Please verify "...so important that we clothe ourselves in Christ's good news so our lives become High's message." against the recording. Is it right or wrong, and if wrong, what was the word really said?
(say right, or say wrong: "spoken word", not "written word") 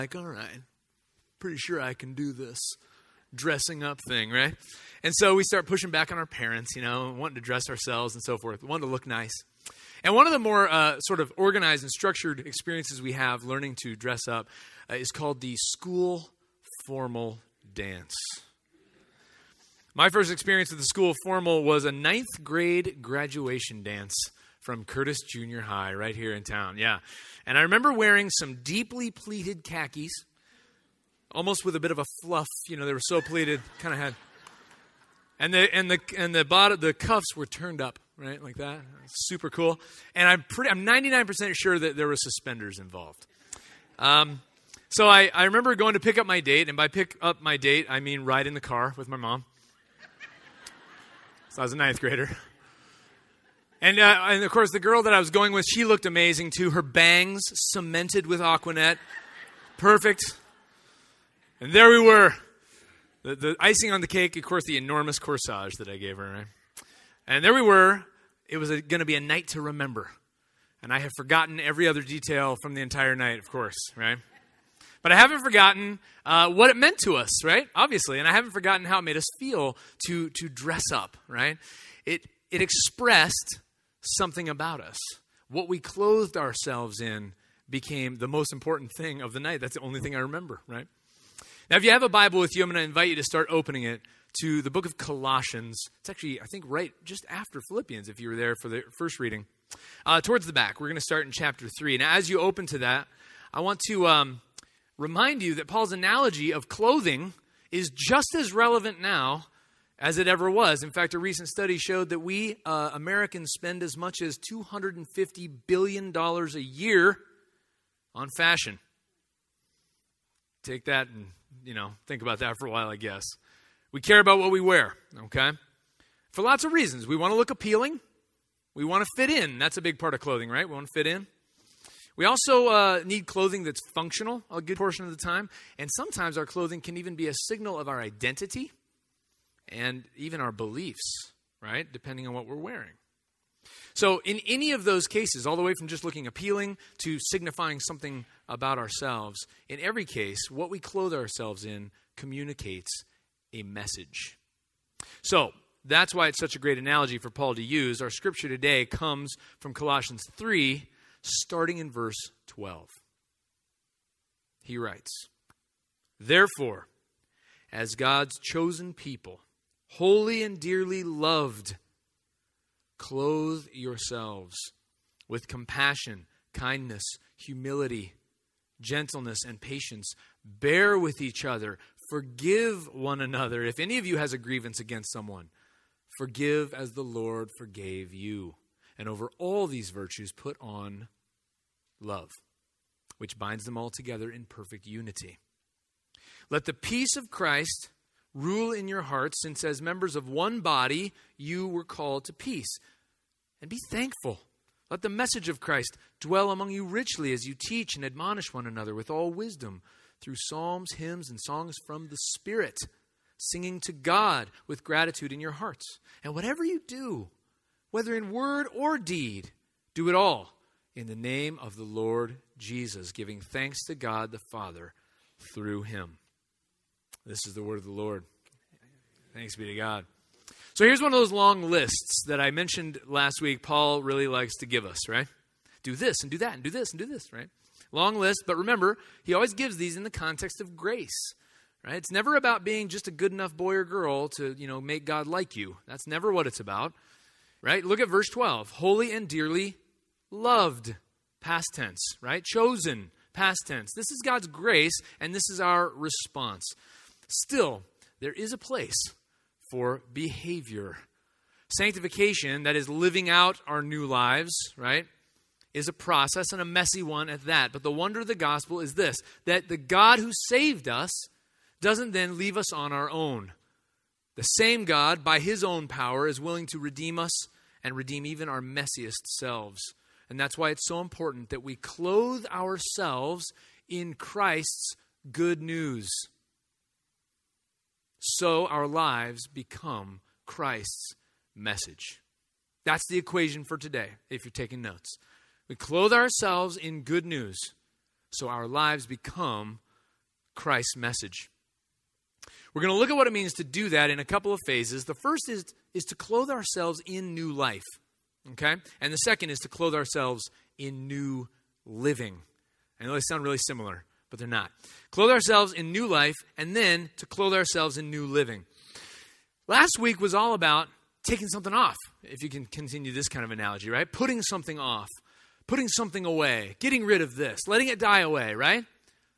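wrong: "Christ", not "High".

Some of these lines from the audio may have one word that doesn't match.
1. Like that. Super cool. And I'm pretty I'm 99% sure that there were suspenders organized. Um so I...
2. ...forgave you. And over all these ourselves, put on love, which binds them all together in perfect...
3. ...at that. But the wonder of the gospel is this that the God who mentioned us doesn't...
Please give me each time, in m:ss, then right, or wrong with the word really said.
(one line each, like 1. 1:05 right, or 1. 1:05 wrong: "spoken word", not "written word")
1. 0:38 wrong: "involved", not "organized"
2. 3:07 wrong: "virtues", not "ourselves"
3. 4:27 wrong: "saved", not "mentioned".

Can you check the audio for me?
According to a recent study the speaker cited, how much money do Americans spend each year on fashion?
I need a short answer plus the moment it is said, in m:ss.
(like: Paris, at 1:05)
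$250 billion, at 1:54.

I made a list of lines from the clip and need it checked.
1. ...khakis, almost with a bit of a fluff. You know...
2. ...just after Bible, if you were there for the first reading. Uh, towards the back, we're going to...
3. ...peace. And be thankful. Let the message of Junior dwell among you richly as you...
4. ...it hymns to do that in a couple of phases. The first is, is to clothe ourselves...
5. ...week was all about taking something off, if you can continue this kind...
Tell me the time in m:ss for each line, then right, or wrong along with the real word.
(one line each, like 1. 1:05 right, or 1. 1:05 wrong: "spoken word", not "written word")
1. 0:29 right
2. 1:37 wrong: "Philippians", not "Bible"
3. 3:22 wrong: "Christ", not "Junior"
4. 5:03 wrong: "means", not "hymns"
5. 5:19 right.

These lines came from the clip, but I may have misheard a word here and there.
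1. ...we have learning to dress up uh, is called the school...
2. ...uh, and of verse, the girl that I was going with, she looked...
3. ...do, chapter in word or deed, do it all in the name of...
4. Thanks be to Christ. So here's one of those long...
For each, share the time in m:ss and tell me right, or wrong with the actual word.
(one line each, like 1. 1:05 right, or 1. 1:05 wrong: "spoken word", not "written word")
1. 0:13 right
2. 0:53 wrong: "course", not "verse"
3. 3:36 wrong: "whether", not "chapter"
4. 3:49 wrong: "God", not "Christ".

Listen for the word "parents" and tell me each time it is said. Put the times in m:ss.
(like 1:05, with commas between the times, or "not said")
0:06.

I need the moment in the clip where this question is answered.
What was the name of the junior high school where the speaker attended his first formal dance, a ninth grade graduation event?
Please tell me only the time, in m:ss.
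0:24.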